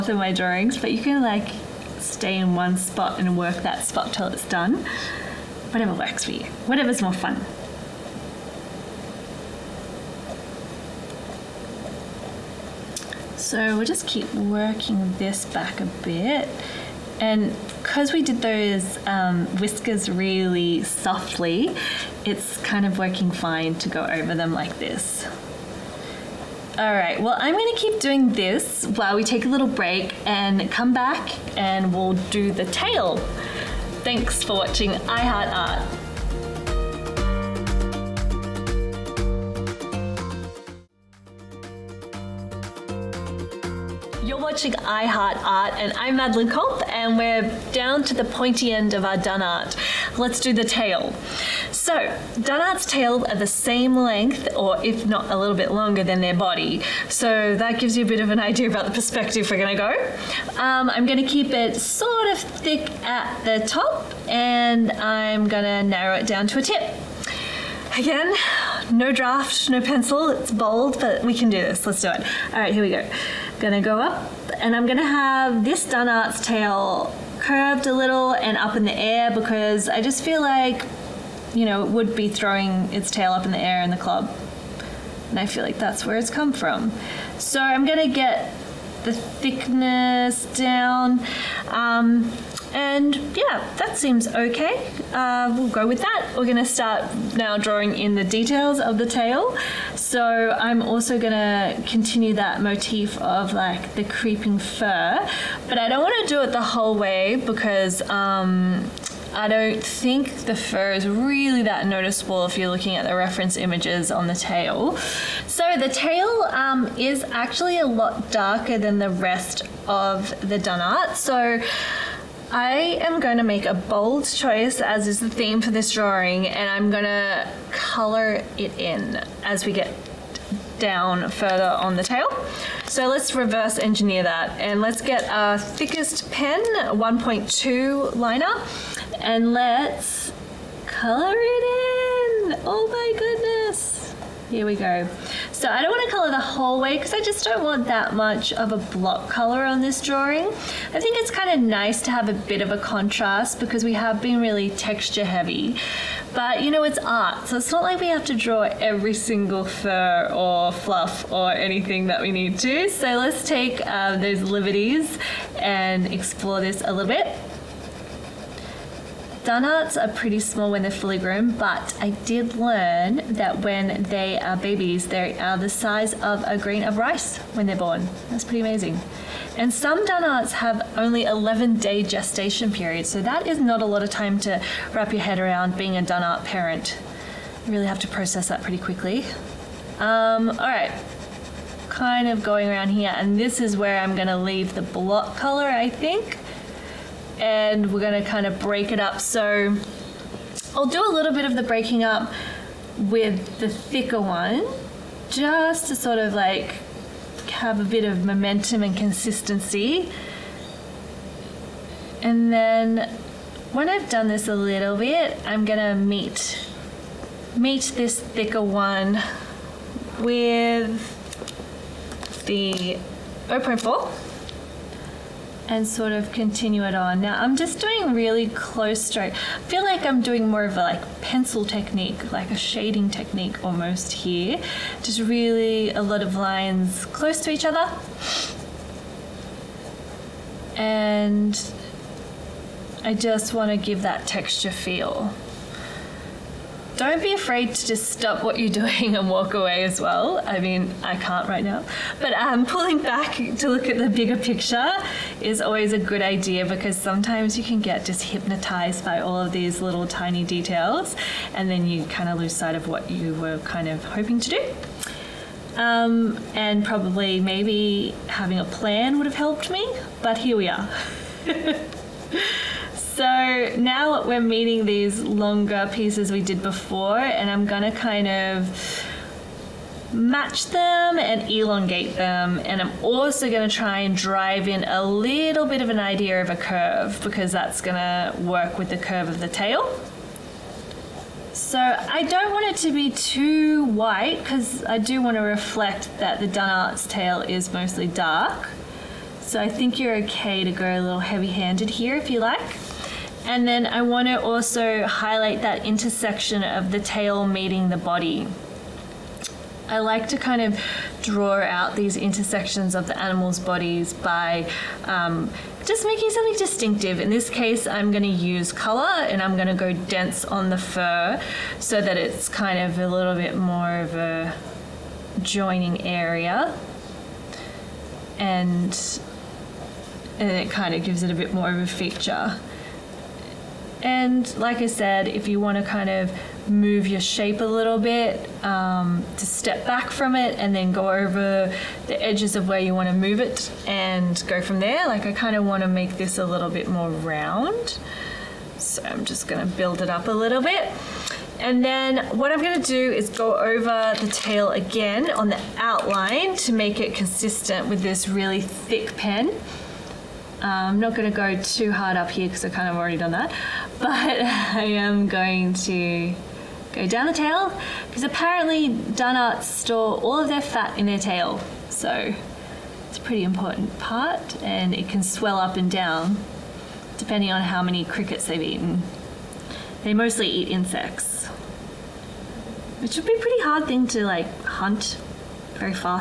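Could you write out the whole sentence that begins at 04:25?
Um, and probably maybe having a plan would have helped me, but here we are.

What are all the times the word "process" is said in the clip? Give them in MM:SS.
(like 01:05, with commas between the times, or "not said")
03:08.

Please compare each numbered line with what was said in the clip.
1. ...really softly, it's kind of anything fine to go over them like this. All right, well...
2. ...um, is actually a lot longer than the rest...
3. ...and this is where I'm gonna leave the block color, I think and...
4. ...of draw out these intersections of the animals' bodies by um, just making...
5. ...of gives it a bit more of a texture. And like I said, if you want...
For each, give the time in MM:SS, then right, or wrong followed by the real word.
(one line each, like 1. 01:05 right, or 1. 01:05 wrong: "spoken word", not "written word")
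1. 00:20 wrong: "working", not "anything"
2. 01:56 wrong: "darker", not "longer"
3. 03:13 right
4. 05:10 right
5. 05:30 wrong: "feature", not "texture".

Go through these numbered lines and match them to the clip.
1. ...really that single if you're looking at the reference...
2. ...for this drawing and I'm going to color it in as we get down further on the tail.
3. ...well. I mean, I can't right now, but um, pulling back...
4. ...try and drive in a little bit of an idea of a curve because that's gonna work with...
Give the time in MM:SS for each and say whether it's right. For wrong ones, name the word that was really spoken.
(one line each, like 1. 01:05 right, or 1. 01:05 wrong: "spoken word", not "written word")
1. 01:51 wrong: "noticeable", not "single"
2. 02:05 right
3. 04:10 right
4. 04:43 right.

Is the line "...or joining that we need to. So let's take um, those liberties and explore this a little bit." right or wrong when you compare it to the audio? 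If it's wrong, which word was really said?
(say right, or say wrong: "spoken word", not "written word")
wrong: "anything", not "joining".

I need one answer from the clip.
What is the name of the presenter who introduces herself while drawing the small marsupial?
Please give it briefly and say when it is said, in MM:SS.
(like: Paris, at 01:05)
Madeleine Culp, at 00:46.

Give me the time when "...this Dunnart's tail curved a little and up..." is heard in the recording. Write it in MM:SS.
01:15.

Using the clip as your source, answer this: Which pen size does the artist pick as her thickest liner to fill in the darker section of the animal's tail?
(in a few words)
1.2.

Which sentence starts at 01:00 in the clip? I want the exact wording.
Um, I'm gonna keep it sort of thick at the top, and I'm gonna narrow it down to a tip.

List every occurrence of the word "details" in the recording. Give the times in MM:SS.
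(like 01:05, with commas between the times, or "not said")
01:38, 04:20.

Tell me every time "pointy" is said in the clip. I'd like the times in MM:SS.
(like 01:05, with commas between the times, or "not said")
00:48.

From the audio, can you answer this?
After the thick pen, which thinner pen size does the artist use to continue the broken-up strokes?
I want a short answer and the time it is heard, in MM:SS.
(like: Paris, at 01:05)
0.4, at 03:43.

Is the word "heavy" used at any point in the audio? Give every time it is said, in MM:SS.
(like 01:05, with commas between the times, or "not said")
02:35, 05:01.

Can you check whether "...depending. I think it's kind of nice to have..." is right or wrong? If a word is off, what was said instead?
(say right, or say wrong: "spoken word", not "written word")
wrong: "drawing", not "depending".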